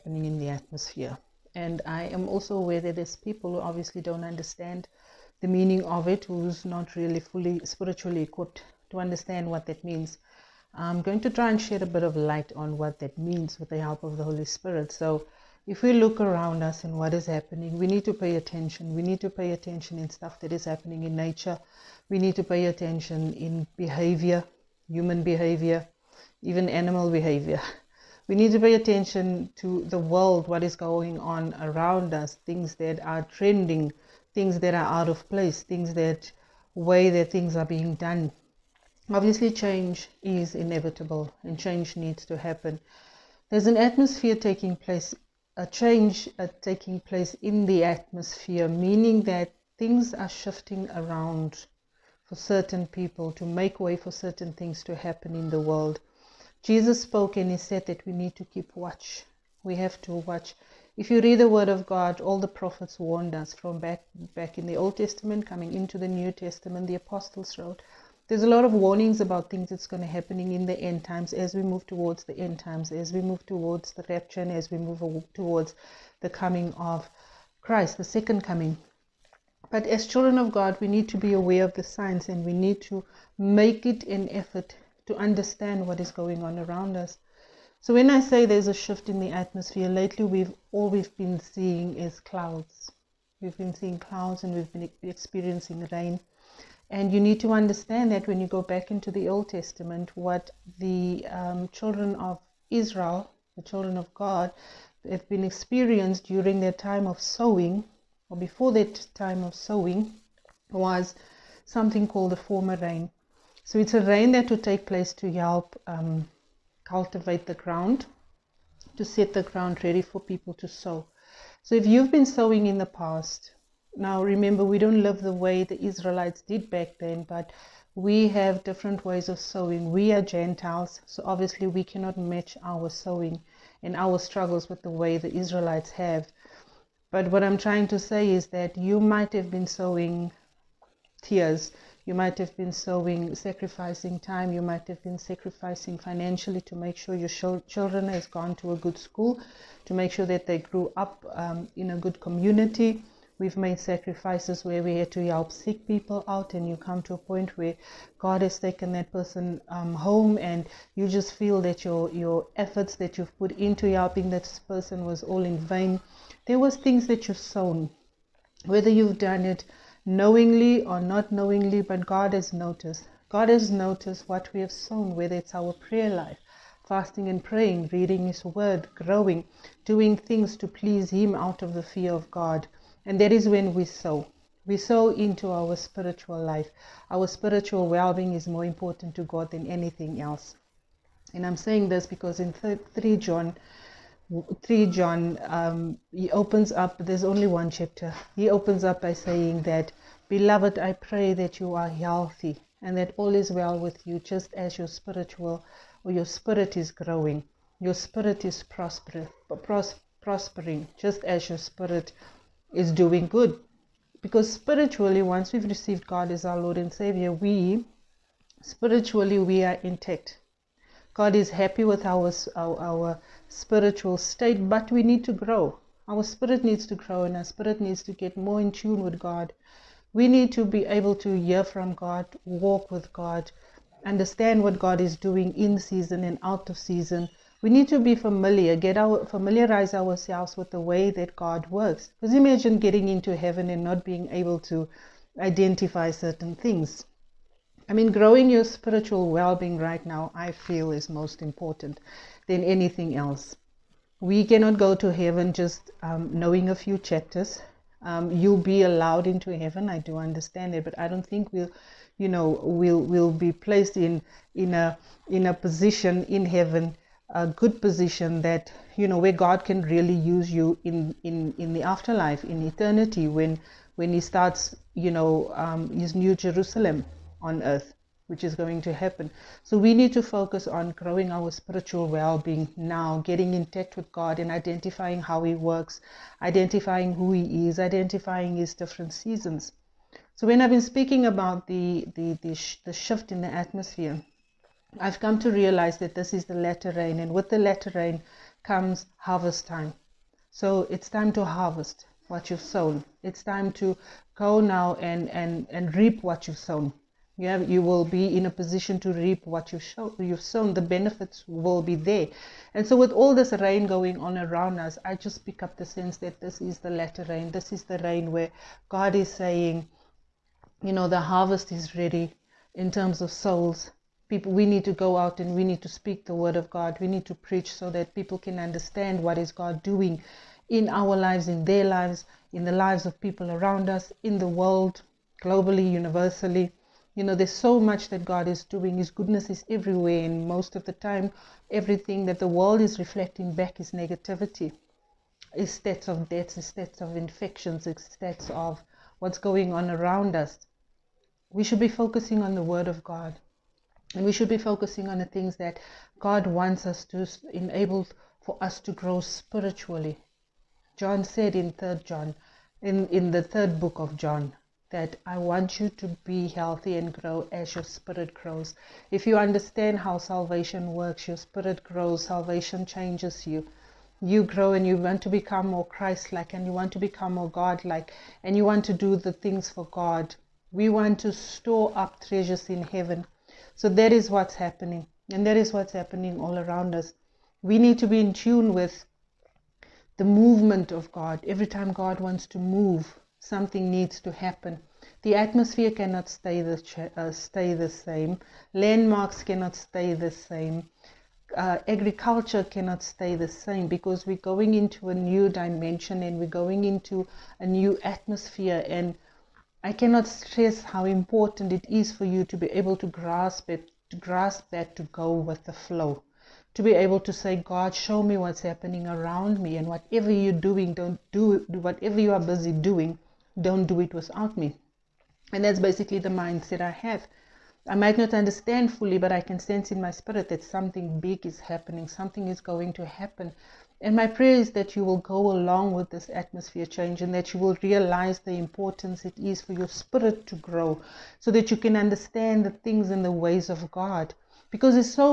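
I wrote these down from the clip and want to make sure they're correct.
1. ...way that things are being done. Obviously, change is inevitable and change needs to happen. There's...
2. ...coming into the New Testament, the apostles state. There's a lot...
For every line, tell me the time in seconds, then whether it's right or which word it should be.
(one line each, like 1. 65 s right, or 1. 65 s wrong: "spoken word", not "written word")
1. 36 s right
2. 65 s wrong: "wrote", not "state".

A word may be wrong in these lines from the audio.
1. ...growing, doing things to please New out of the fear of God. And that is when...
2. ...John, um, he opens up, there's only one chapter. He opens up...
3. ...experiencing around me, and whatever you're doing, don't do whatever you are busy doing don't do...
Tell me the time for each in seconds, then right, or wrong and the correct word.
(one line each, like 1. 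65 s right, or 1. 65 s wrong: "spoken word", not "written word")
1. 178 s wrong: "Him", not "New"
2. 194 s right
3. 418 s wrong: "happening", not "experiencing".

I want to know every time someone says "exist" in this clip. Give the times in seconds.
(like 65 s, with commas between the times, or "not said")
not said.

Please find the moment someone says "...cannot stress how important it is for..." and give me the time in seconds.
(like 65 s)
409 s.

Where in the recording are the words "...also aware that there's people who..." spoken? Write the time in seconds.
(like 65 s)
2 s.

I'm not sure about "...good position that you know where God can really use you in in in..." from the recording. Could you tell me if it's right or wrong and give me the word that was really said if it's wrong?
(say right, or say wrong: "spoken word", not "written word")
right.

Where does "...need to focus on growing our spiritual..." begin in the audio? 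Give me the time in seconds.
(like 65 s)
279 s.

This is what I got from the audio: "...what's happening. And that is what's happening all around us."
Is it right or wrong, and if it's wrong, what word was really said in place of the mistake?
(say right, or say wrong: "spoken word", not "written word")
right.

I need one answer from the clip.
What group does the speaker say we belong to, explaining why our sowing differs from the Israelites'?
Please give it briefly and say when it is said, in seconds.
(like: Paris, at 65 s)
Gentiles, at 130 s.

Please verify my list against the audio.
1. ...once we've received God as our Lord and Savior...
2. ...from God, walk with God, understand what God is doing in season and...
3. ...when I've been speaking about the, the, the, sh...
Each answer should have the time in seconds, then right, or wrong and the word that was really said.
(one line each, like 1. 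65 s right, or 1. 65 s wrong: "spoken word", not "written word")
1. 215 s right
2. 231 s right
3. 290 s right.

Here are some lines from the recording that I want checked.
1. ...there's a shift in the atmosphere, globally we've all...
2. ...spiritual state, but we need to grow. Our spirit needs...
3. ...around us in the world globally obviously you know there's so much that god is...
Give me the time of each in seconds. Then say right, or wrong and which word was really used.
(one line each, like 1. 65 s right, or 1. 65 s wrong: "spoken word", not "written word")
1. 88 s wrong: "lately", not "globally"
2. 223 s right
3. 333 s wrong: "universally", not "obviously".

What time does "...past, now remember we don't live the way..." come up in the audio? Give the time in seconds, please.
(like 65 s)
122 s.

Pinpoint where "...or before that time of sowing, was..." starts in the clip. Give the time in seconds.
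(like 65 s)
108 s.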